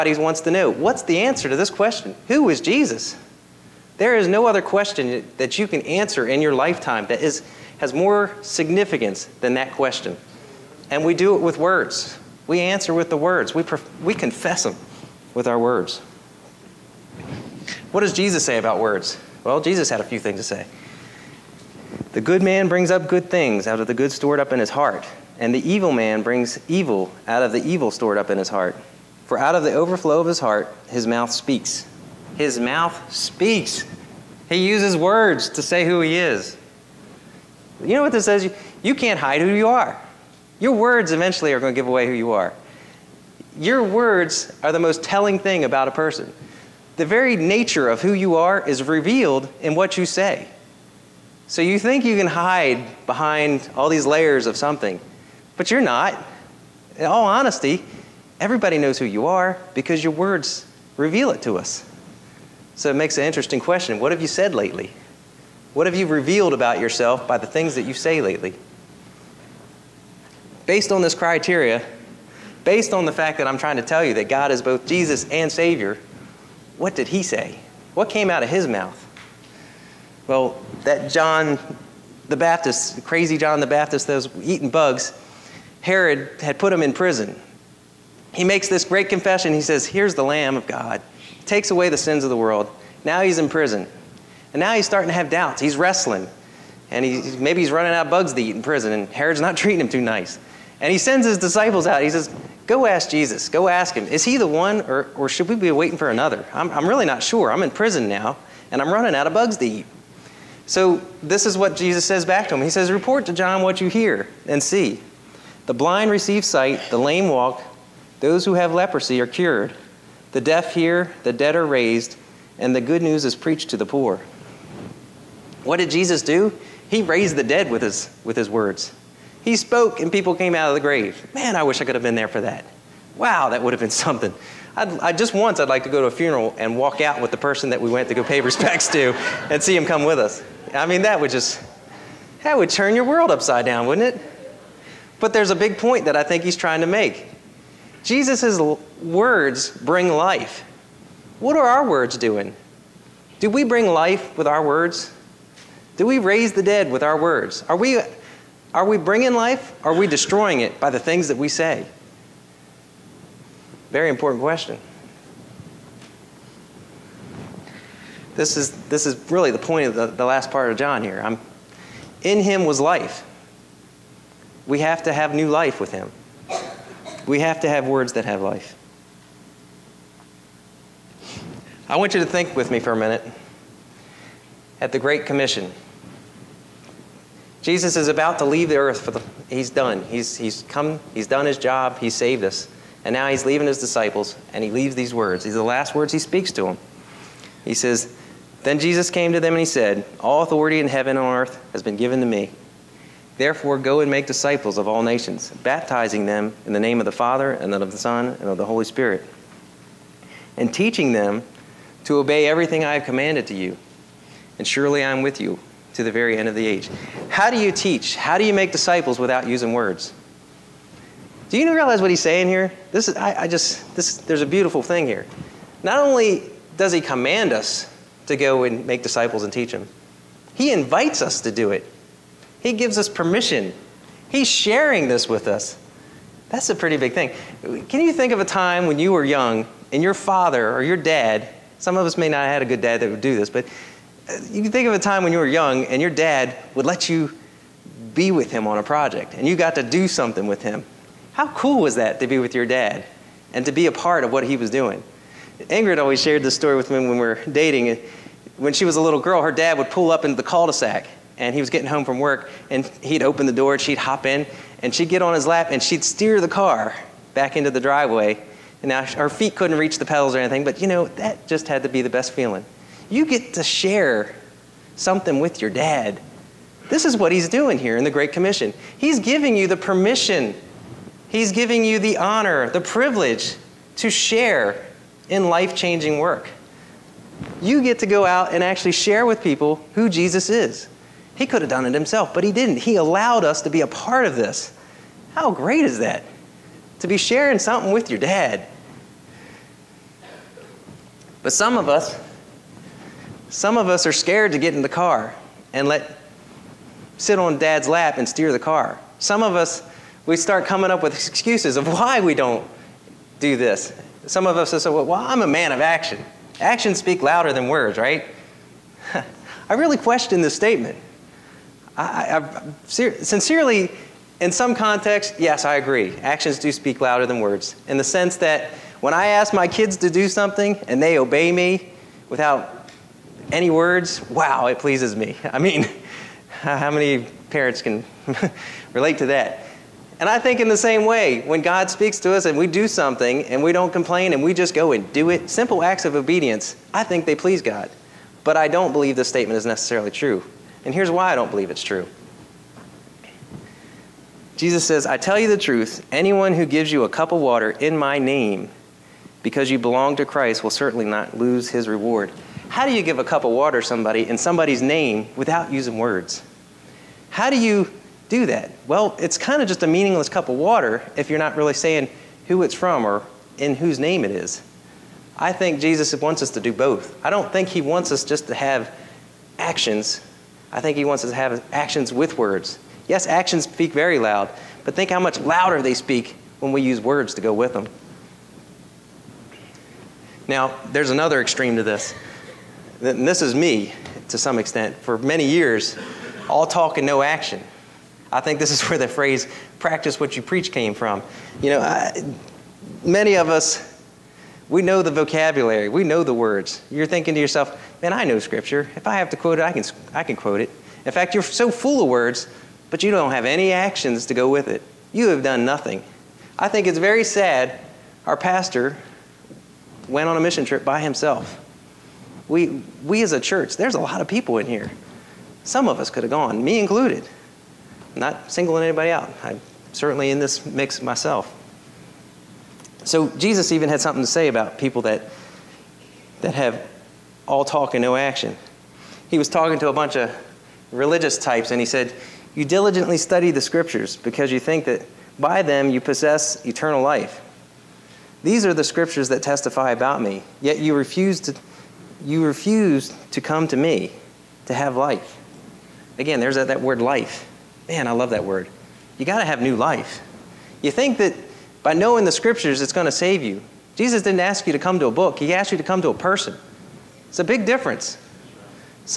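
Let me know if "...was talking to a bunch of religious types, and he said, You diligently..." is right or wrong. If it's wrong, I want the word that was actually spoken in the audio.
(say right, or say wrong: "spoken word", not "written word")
right.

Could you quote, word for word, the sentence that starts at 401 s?
You know, I, many of us we know the vocabulary, we know the words.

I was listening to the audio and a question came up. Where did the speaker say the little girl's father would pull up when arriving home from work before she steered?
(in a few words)
The cul-de-sac.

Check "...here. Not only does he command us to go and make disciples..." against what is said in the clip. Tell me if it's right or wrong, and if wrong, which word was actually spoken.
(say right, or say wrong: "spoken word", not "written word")
right.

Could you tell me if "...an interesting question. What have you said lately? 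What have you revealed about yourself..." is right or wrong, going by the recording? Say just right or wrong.
right.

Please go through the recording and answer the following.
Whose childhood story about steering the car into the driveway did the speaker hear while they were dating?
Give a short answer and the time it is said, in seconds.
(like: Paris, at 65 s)
Ingrid, at 255 s.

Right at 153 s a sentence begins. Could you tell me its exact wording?
Do we bring life with our words?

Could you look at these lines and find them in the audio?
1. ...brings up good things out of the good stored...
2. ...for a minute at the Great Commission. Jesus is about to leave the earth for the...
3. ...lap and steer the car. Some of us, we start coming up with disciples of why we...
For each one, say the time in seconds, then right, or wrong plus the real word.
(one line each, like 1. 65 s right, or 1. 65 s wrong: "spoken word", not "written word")
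1. 22 s right
2. 182 s right
3. 307 s wrong: "excuses", not "disciples".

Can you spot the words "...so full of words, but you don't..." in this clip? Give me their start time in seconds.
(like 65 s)
411 s.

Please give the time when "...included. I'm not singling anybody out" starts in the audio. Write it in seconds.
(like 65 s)
426 s.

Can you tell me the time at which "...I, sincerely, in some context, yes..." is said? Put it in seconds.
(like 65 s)
322 s.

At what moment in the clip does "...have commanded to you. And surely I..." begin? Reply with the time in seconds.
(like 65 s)
212 s.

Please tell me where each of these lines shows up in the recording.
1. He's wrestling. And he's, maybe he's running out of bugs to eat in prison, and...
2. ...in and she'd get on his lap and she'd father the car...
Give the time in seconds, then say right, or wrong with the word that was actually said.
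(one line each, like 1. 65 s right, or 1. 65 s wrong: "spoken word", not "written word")
1. 95 s right
2. 264 s wrong: "steer", not "father".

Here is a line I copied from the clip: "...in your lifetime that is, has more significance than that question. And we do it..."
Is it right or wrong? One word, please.
right.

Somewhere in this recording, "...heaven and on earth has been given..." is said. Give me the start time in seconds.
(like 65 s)
200 s.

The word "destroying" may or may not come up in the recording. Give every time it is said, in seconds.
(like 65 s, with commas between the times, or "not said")
160 s.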